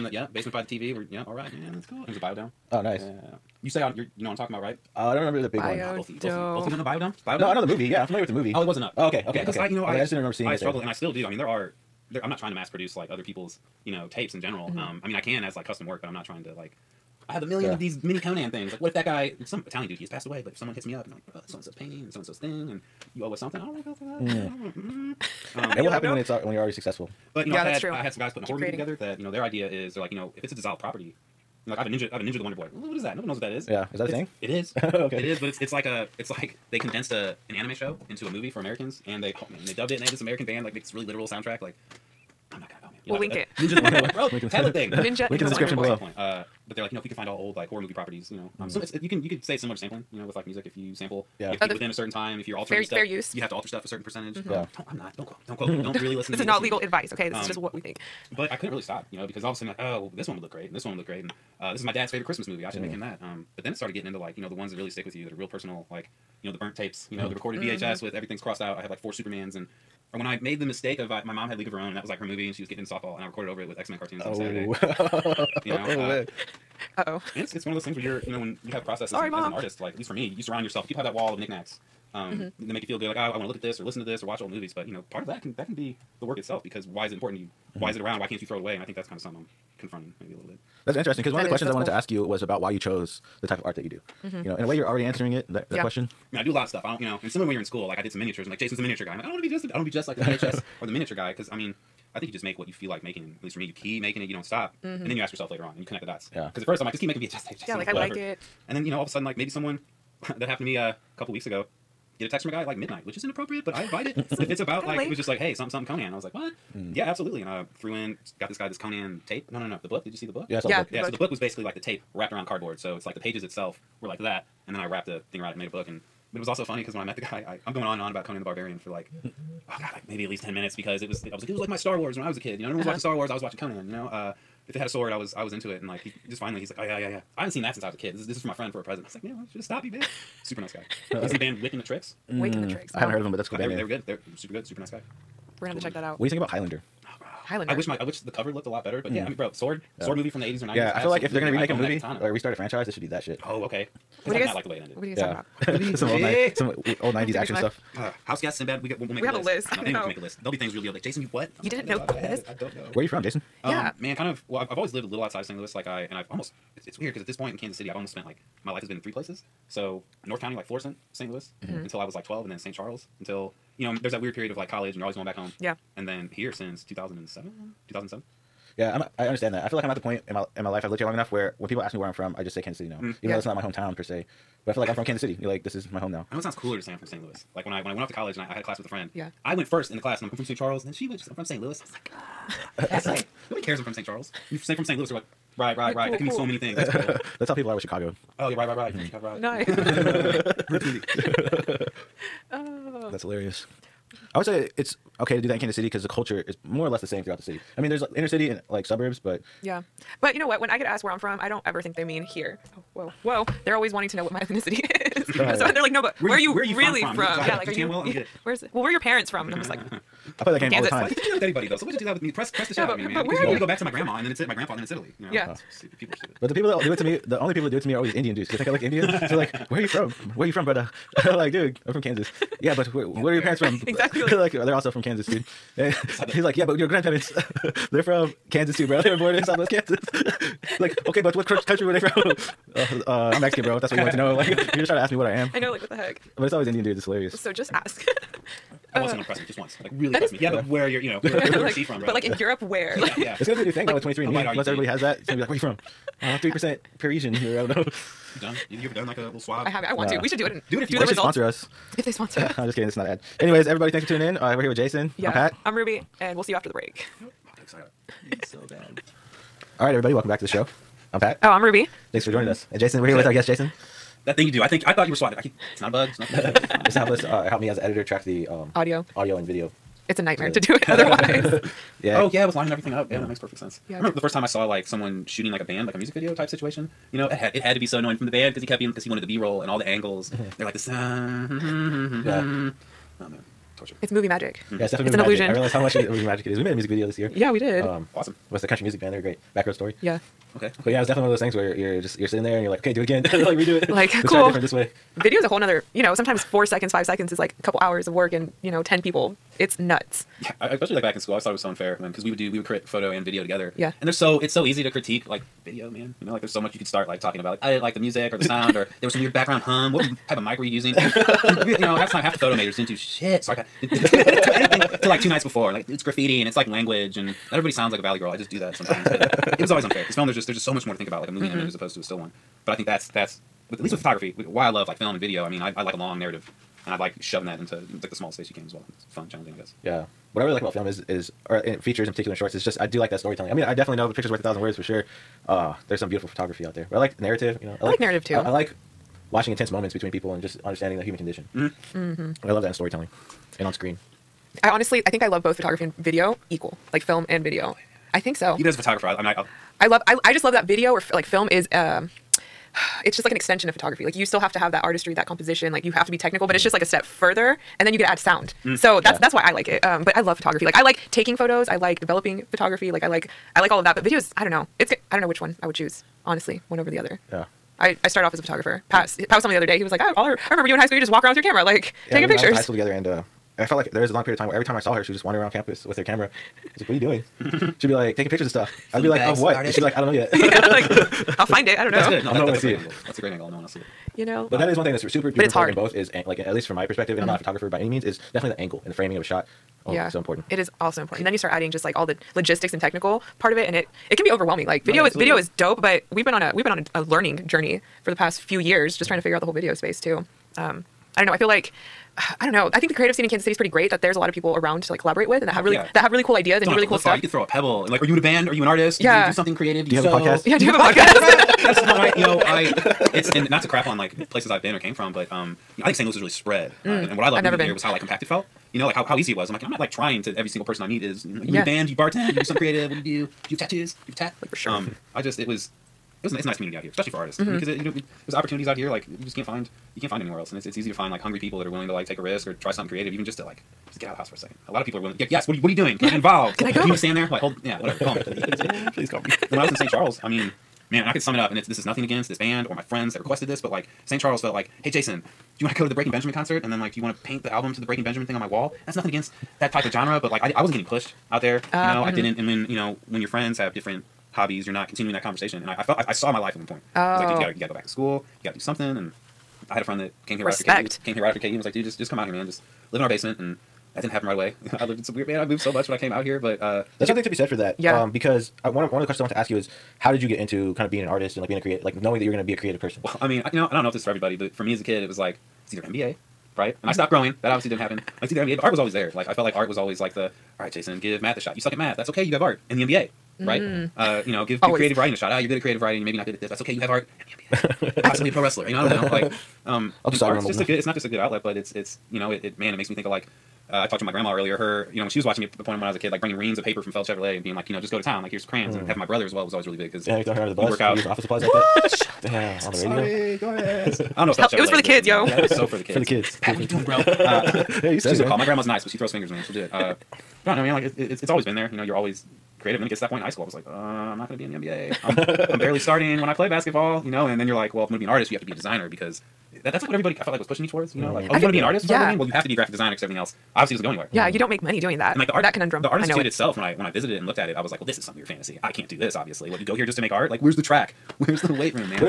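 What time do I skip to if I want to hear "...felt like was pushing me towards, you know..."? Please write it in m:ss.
8:50.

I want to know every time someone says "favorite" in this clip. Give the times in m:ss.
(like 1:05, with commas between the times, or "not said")
1:02.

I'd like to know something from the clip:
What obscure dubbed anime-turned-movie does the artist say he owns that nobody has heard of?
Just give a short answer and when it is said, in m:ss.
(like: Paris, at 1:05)
Ninja the Wonder Boy, at 0:32.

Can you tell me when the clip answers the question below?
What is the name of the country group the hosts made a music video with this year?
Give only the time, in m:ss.
4:59.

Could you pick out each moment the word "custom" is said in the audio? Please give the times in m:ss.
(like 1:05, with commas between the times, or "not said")
0:15.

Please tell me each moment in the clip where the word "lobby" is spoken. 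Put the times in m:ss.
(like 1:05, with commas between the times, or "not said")
not said.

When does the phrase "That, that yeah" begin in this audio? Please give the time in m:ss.
1:35.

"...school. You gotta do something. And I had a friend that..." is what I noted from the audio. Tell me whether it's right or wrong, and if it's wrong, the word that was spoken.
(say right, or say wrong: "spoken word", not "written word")
right.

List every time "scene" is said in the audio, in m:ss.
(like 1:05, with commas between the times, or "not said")
6:53.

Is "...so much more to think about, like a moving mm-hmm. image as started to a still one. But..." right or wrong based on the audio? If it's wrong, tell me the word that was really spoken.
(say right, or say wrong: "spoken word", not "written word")
wrong: "opposed", not "started".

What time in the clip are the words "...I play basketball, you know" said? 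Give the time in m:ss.
8:46.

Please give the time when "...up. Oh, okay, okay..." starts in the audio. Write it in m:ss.
0:08.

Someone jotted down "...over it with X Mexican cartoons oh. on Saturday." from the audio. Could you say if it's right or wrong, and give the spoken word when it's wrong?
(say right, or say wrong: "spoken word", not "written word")
wrong: "Men", not "Mexican".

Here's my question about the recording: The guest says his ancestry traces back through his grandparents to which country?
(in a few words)
Italy.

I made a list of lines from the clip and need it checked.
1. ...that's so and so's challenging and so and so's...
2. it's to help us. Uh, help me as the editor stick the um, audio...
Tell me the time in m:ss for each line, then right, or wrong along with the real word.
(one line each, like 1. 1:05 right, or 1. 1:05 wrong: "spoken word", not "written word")
1. 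0:21 wrong: "painting", not "challenging"
2. 4:36 wrong: "track", not "stick".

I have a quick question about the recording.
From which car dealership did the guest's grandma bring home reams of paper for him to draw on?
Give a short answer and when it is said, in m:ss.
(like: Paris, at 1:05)
Feld Chevrolet, at 8:26.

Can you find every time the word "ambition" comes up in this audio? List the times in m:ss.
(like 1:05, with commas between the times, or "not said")
not said.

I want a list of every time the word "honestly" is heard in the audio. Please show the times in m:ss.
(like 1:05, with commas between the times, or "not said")
5:54, 6:16.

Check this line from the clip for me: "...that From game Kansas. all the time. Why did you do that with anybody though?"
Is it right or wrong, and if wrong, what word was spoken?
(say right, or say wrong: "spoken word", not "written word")
right.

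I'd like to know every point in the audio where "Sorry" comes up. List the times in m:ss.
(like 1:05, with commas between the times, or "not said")
1:19, 5:23, 8:32.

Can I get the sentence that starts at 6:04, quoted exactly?
Like you still have to have that artistry, that composition, like you have to be technical, but mm-hmm.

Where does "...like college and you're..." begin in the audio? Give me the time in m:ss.
2:54.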